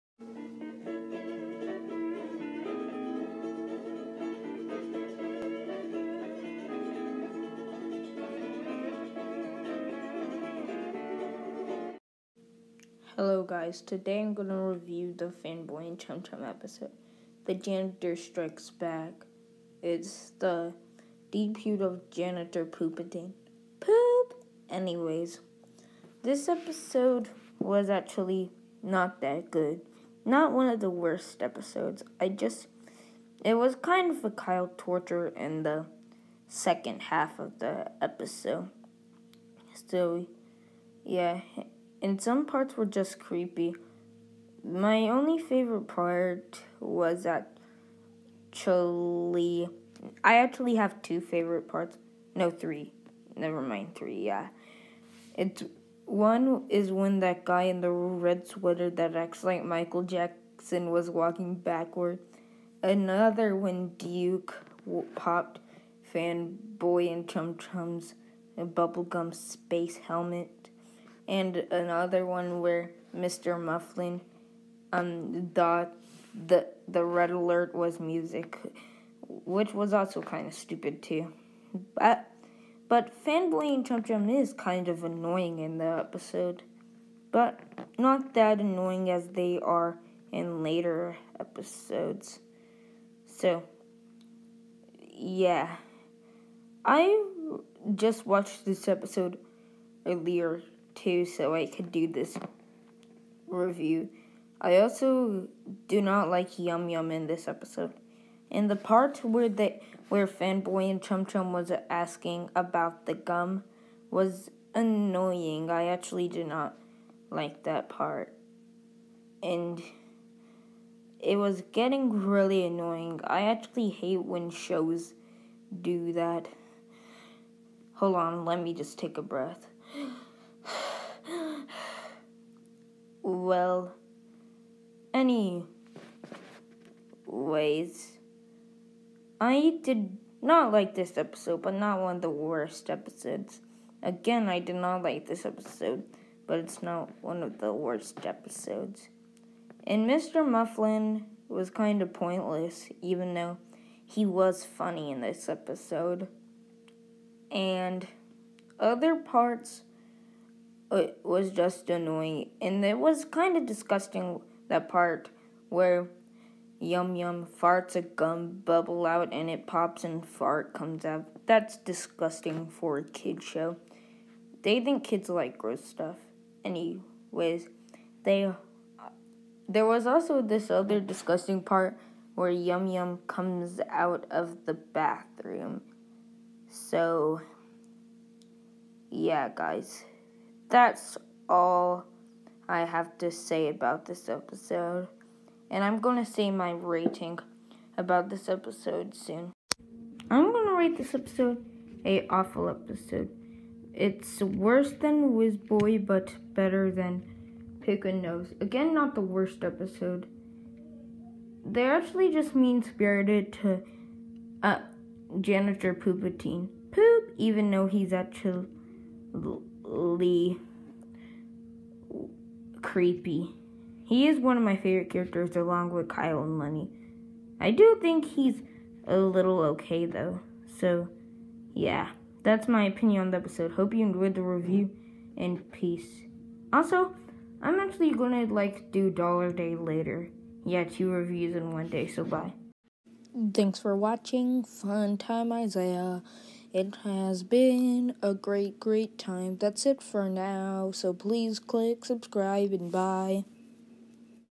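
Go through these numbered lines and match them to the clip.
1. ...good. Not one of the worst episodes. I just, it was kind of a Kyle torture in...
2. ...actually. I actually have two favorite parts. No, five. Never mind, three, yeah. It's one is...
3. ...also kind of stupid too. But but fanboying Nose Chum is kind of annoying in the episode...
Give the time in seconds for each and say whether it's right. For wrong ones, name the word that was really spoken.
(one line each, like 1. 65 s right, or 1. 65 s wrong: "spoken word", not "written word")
1. 29 s right
2. 47 s wrong: "three", not "five"
3. 79 s wrong: "Chum", not "Nose".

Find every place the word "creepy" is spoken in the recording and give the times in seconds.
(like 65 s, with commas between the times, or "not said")
43 s, 222 s.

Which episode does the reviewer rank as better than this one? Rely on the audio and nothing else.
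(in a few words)
Whiz Boy.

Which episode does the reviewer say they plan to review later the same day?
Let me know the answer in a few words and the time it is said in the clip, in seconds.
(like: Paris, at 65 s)
Dollar Day, at 239 s.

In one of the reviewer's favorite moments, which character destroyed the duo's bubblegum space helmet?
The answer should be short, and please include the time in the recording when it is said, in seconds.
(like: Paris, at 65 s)
Duke, at 63 s.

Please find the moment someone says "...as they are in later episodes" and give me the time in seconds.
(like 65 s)
89 s.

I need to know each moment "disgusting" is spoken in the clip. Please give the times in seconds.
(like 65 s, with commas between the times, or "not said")
163 s, 171 s, 180 s.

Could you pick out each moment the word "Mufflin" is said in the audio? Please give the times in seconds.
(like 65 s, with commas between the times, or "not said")
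73 s, 150 s.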